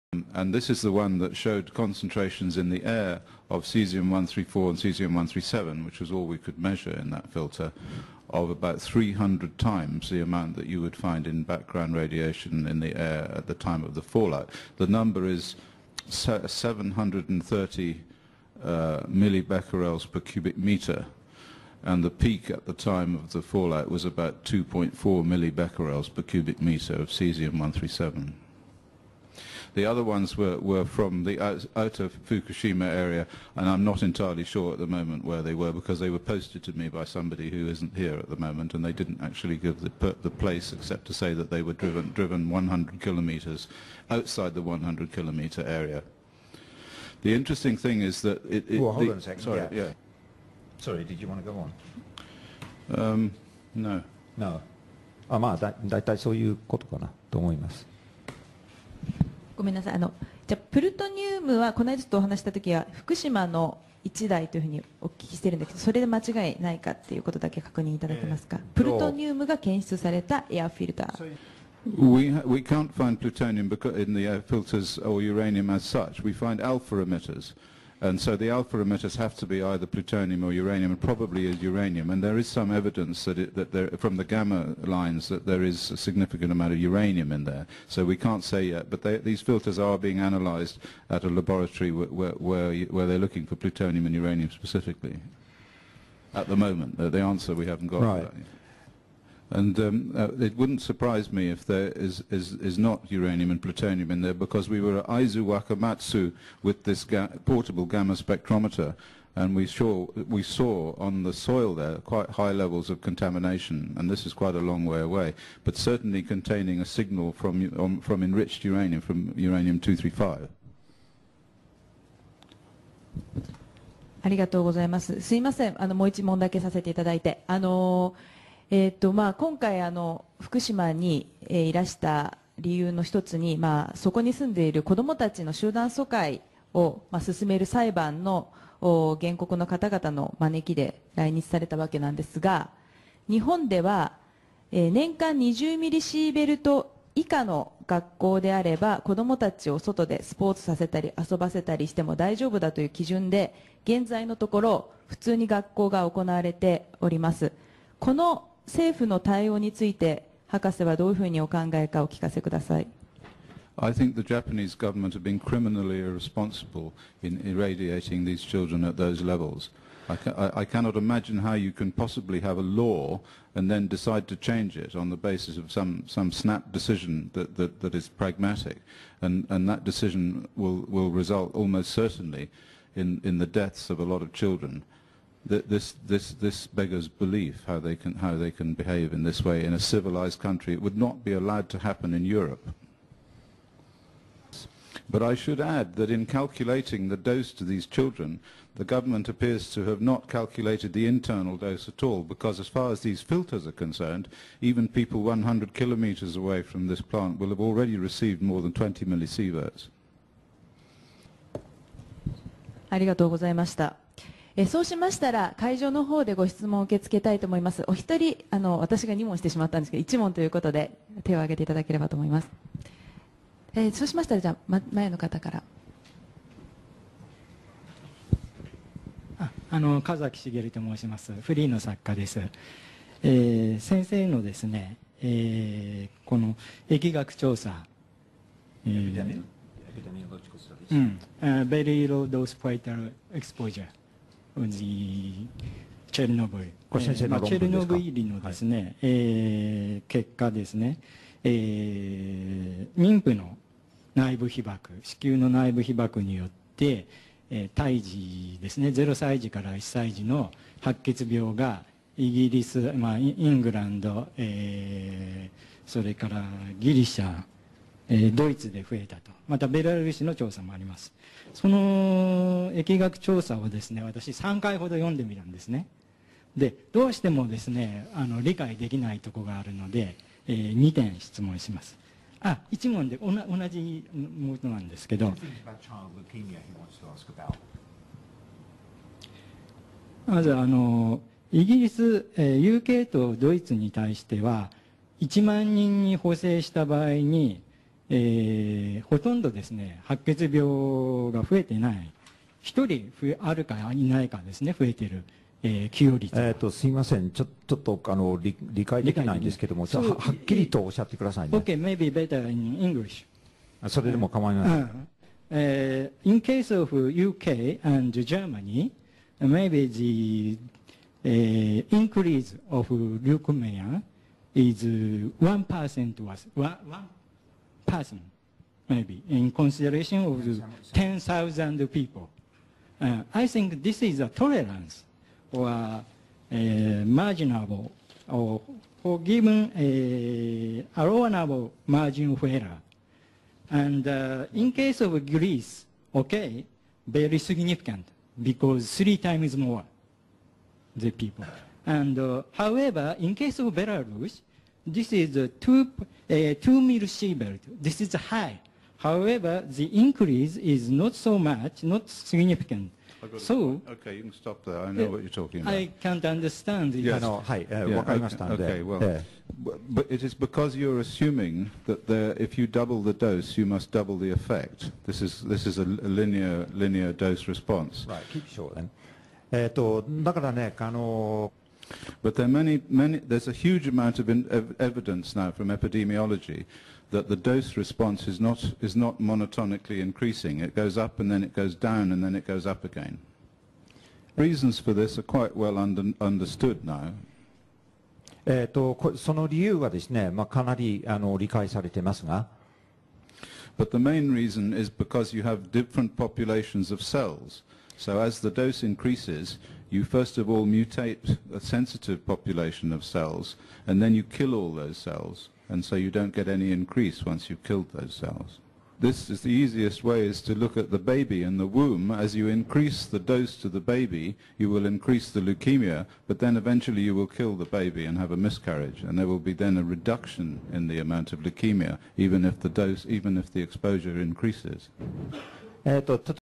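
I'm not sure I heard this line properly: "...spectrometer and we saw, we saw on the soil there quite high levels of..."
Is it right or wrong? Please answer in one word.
right.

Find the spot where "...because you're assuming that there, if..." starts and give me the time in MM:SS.
06:10.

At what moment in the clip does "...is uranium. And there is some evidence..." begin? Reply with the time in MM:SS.
01:21.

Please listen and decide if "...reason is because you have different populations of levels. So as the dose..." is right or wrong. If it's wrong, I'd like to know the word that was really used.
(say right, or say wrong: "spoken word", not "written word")
wrong: "cells", not "levels".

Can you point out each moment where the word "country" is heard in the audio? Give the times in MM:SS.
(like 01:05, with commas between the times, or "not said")
03:10.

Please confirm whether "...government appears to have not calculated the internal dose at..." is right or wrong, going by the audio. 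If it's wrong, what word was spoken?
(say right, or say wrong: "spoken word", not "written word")
right.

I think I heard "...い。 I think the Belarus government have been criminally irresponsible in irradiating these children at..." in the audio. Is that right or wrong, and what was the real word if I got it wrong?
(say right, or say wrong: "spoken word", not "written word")
wrong: "Japanese", not "Belarus".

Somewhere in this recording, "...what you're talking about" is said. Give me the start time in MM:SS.
06:05.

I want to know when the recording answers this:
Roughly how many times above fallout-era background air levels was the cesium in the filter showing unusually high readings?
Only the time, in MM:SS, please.
00:08.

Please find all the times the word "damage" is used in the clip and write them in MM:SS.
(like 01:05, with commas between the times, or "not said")
not said.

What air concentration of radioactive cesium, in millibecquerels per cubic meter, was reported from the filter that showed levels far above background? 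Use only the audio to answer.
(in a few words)
730.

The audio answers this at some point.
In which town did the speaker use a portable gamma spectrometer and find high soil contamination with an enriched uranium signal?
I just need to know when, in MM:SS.
01:45.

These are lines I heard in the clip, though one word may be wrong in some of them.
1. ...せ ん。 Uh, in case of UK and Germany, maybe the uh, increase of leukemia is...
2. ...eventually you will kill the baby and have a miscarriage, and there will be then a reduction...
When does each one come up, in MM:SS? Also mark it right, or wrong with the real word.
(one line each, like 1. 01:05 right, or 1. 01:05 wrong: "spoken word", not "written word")
1. 05:14 right
2. 07:06 right.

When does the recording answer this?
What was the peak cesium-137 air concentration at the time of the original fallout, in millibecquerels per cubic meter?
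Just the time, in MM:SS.
00:24.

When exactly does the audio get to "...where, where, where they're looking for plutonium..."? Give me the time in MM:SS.
01:31.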